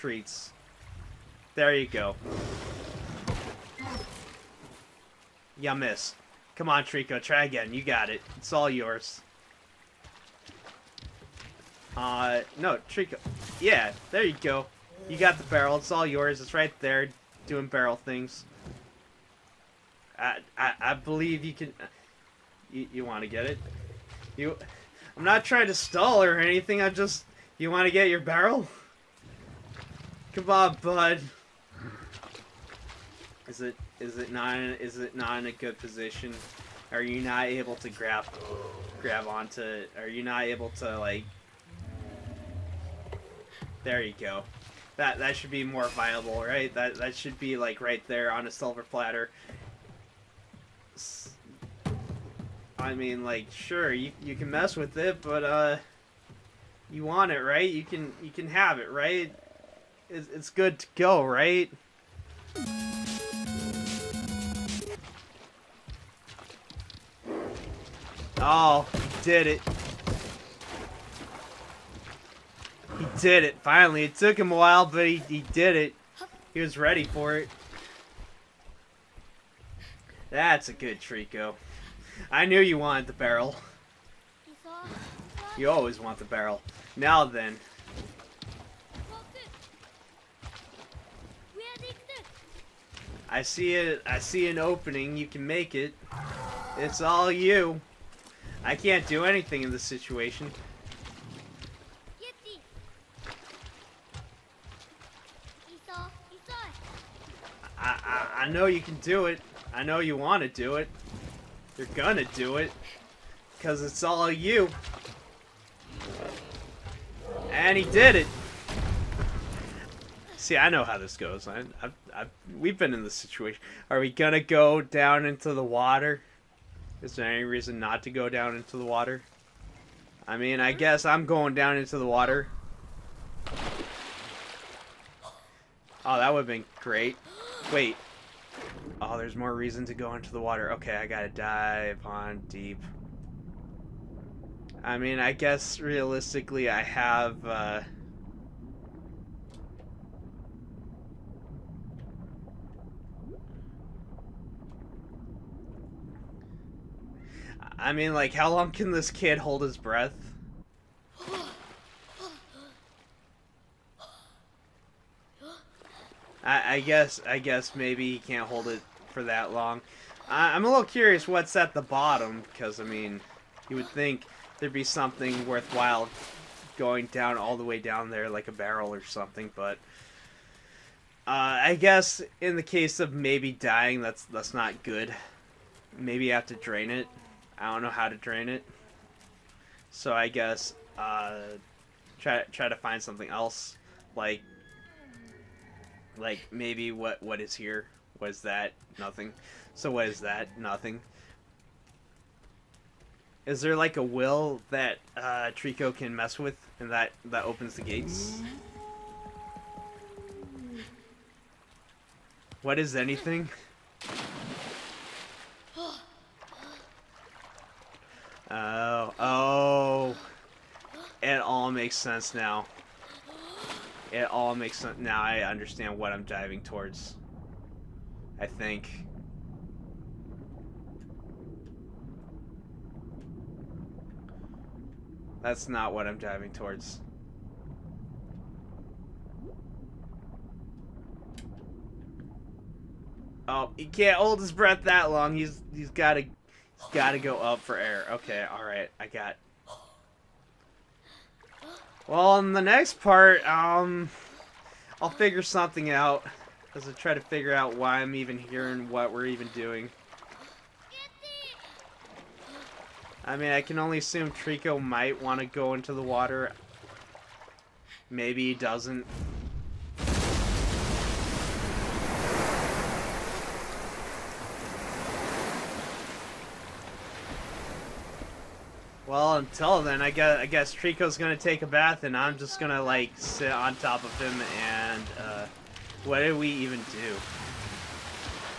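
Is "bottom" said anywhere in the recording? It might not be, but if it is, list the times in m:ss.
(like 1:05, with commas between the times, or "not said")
2:51.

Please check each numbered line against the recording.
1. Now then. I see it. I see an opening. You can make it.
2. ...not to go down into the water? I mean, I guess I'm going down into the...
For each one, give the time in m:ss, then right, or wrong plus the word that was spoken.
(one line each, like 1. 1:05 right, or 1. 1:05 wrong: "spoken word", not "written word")
1. 1:26 right
2. 2:07 right.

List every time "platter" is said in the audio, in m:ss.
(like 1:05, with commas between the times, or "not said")
0:48.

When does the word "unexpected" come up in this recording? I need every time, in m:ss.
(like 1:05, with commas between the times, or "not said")
not said.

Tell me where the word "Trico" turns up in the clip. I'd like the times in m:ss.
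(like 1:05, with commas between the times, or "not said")
0:06, 0:12, 1:20, 3:25, 4:24, 4:40.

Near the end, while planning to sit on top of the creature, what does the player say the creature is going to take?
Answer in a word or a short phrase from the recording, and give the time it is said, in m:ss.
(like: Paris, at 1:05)
a bath, at 4:41.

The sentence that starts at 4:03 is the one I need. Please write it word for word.
Oh, he can't hold his breath that long.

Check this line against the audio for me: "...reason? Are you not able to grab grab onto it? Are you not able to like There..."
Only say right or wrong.
wrong.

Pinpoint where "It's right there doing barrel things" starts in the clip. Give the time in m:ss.
0:16.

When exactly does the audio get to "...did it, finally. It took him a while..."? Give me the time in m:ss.
1:13.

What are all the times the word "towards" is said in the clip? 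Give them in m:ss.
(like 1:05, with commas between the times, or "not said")
3:46, 3:56.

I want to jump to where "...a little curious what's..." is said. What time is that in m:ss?
2:50.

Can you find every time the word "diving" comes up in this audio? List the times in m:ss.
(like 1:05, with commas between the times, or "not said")
3:46, 3:56.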